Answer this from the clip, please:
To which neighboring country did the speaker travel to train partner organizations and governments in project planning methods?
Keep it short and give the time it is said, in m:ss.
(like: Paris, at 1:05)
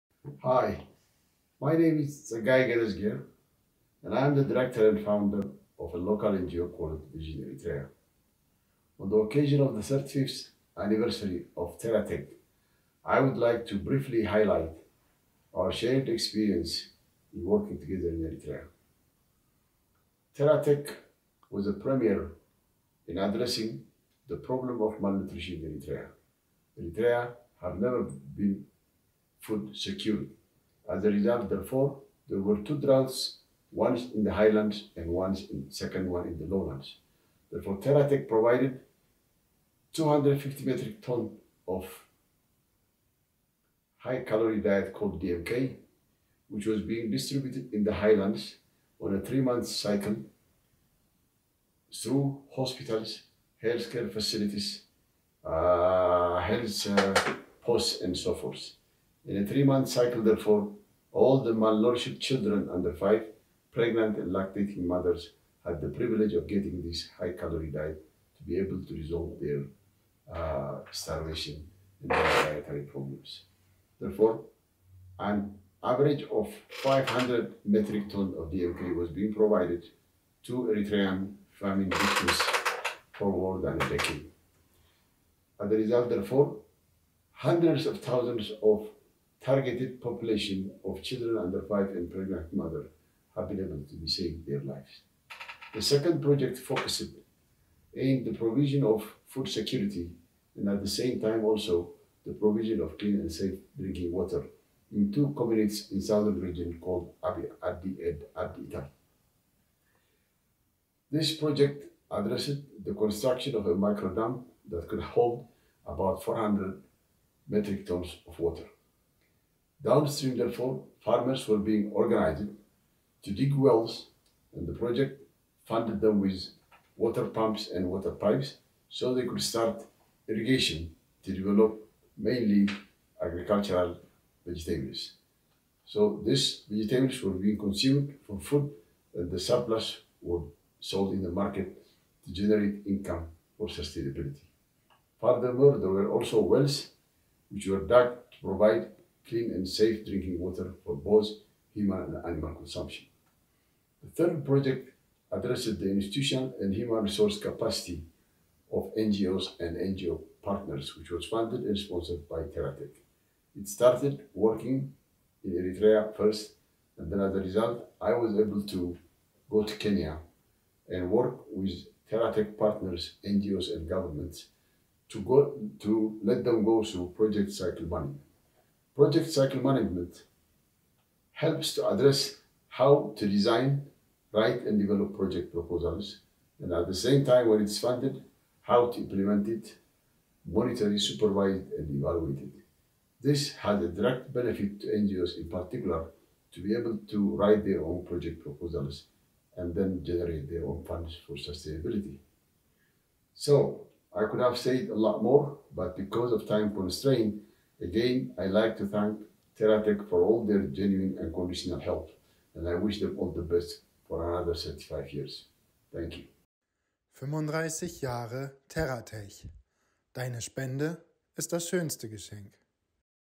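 Kenya, at 2:49.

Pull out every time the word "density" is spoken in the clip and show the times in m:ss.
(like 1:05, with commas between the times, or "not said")
not said.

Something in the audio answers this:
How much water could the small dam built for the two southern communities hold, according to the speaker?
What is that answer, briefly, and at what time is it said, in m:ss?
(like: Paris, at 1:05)
400 metric tons, at 1:56.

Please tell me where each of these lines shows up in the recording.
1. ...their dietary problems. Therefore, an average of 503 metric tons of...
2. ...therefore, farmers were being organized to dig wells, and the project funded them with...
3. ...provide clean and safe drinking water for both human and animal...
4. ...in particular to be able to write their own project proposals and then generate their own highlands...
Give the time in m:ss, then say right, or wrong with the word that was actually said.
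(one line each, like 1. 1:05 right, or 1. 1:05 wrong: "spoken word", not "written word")
1. 1:12 wrong: "500", not "503"
2. 2:00 right
3. 2:28 right
4. 3:15 wrong: "funds", not "highlands".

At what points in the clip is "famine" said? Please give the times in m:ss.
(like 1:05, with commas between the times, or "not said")
1:21.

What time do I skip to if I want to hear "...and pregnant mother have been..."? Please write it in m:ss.
1:31.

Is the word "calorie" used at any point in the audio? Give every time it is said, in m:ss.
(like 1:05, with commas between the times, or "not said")
0:44, 1:07.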